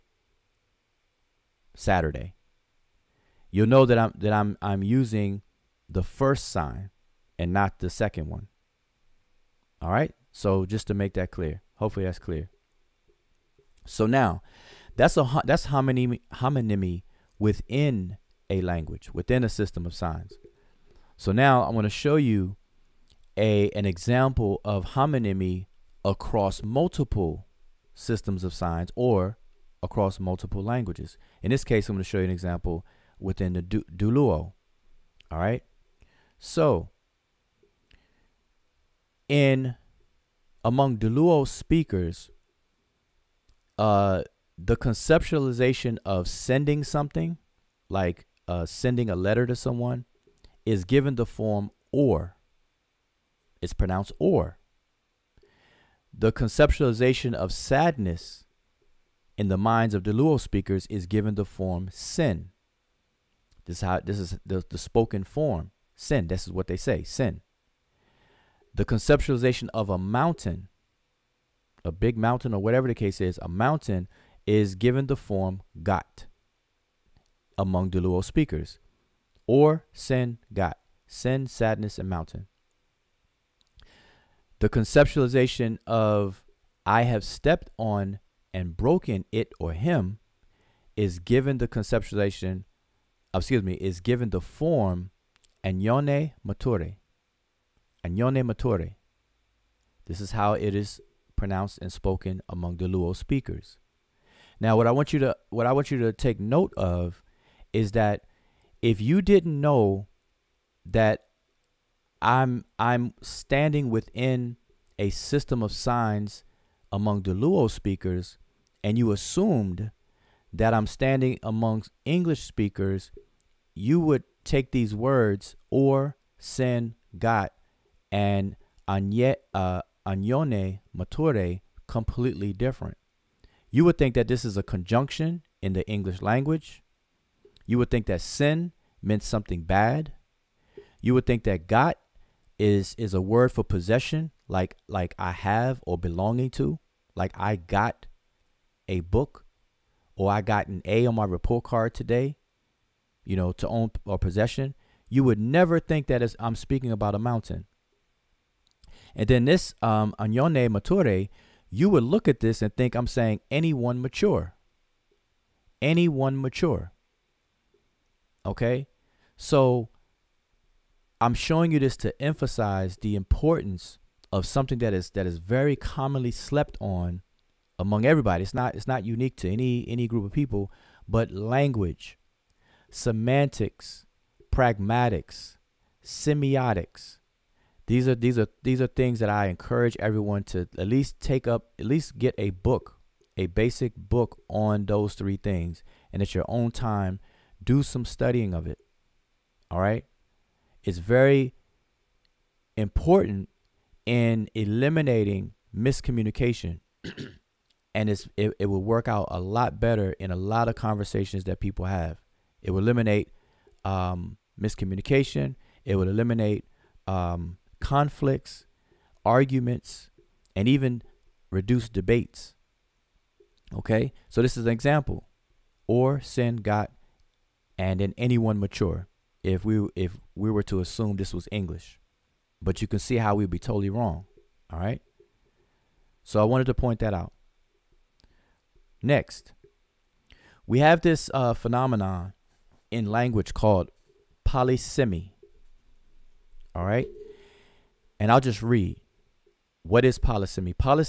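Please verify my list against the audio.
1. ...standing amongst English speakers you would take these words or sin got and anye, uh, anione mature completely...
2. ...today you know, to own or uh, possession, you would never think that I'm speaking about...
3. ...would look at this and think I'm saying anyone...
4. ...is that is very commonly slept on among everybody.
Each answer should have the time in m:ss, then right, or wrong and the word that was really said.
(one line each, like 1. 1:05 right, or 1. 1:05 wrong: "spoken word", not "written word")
1. 2:00 right
2. 2:31 right
3. 2:41 right
4. 2:54 right.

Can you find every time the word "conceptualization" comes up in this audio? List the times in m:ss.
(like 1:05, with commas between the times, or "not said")
0:44, 0:56, 1:08, 1:24, 1:31.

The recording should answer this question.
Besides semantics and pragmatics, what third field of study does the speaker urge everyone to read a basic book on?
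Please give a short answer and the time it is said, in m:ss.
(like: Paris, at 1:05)
semiotics, at 3:06.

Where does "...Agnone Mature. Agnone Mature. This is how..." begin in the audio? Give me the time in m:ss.
1:35.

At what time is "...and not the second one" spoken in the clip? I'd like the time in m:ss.
0:07.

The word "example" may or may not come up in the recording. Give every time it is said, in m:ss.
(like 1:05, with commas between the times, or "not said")
0:23, 0:32, 3:44.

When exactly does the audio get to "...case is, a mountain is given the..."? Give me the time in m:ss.
1:12.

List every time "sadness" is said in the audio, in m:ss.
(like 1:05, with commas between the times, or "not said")
0:57, 1:21.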